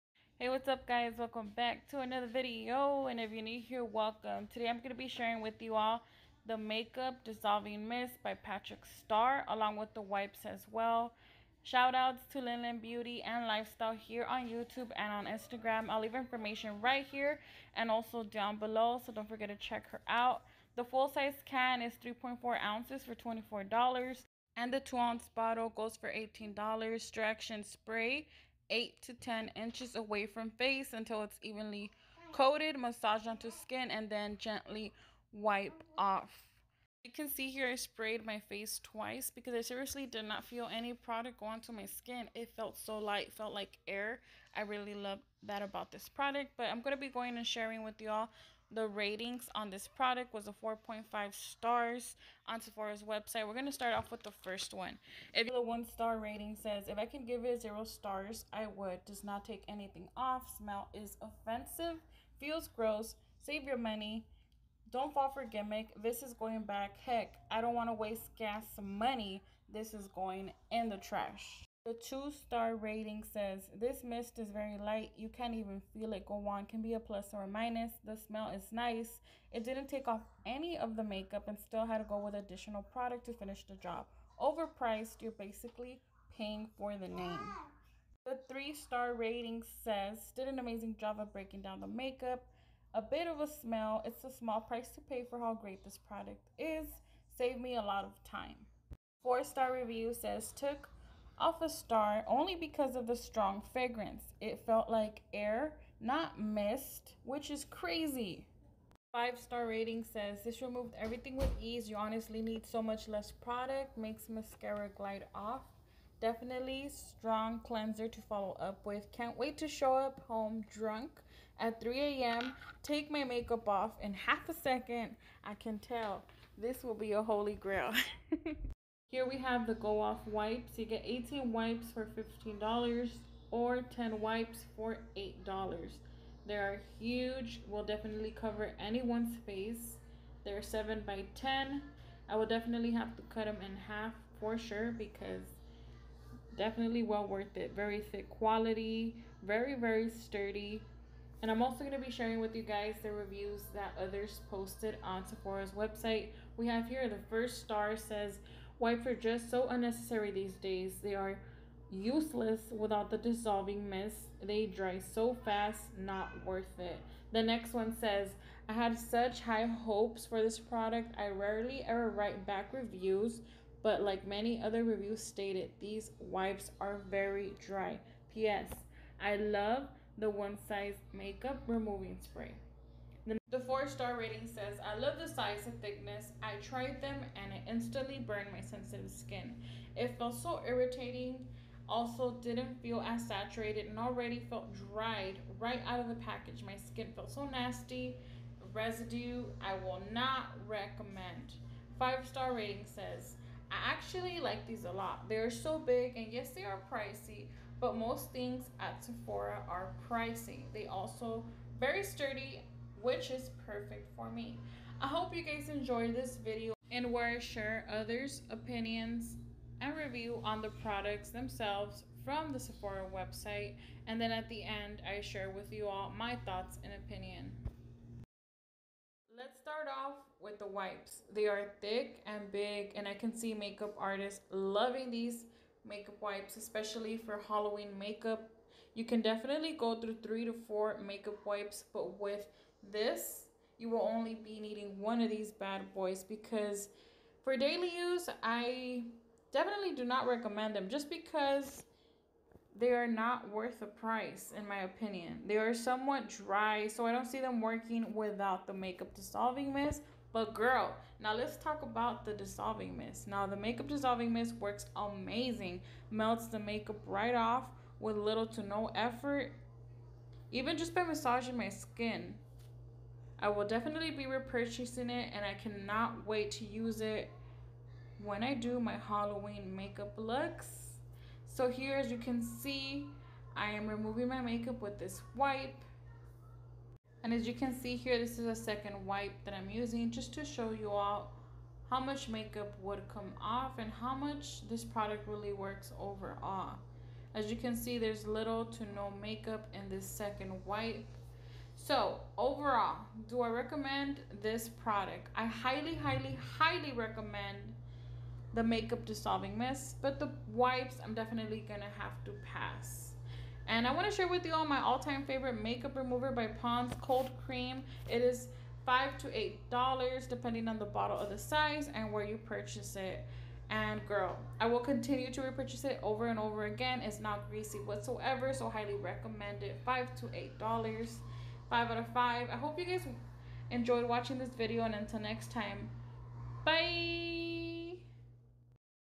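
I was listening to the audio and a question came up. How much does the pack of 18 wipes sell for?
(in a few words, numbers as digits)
$15.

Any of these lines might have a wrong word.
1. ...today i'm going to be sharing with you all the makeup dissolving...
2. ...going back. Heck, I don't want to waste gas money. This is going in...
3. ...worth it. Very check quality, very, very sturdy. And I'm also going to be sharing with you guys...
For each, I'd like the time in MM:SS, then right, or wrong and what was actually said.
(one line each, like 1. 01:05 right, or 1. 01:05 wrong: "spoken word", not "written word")
1. 00:04 right
2. 01:06 right
3. 02:27 wrong: "thick", not "check".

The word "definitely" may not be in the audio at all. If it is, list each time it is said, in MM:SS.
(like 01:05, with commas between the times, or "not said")
01:56, 02:17, 02:22, 02:26, 03:59, 04:09, 04:33, 05:11.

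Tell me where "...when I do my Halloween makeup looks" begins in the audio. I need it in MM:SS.
04:38.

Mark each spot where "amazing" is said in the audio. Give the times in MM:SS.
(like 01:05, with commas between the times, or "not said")
01:30, 04:24.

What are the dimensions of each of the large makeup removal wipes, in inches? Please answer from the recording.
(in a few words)
7 by 10.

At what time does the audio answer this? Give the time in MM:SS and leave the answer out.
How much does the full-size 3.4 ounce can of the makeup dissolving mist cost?
00:23.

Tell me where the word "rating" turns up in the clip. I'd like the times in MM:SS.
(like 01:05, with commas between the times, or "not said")
00:48, 00:56, 01:12, 01:29, 01:49, 03:04, 03:22.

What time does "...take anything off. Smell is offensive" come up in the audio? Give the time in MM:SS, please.
00:59.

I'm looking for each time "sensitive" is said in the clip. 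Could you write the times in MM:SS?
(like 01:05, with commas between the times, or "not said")
03:08.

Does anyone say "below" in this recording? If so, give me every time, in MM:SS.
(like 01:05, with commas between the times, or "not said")
00:18.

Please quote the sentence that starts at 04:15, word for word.
They are somewhat dry, so I don't see them working without the makeup dissolving mist.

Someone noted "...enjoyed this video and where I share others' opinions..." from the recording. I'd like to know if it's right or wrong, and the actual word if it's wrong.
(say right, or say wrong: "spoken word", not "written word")
right.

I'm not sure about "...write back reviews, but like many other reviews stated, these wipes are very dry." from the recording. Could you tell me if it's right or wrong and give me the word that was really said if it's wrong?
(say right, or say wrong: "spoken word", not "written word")
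right.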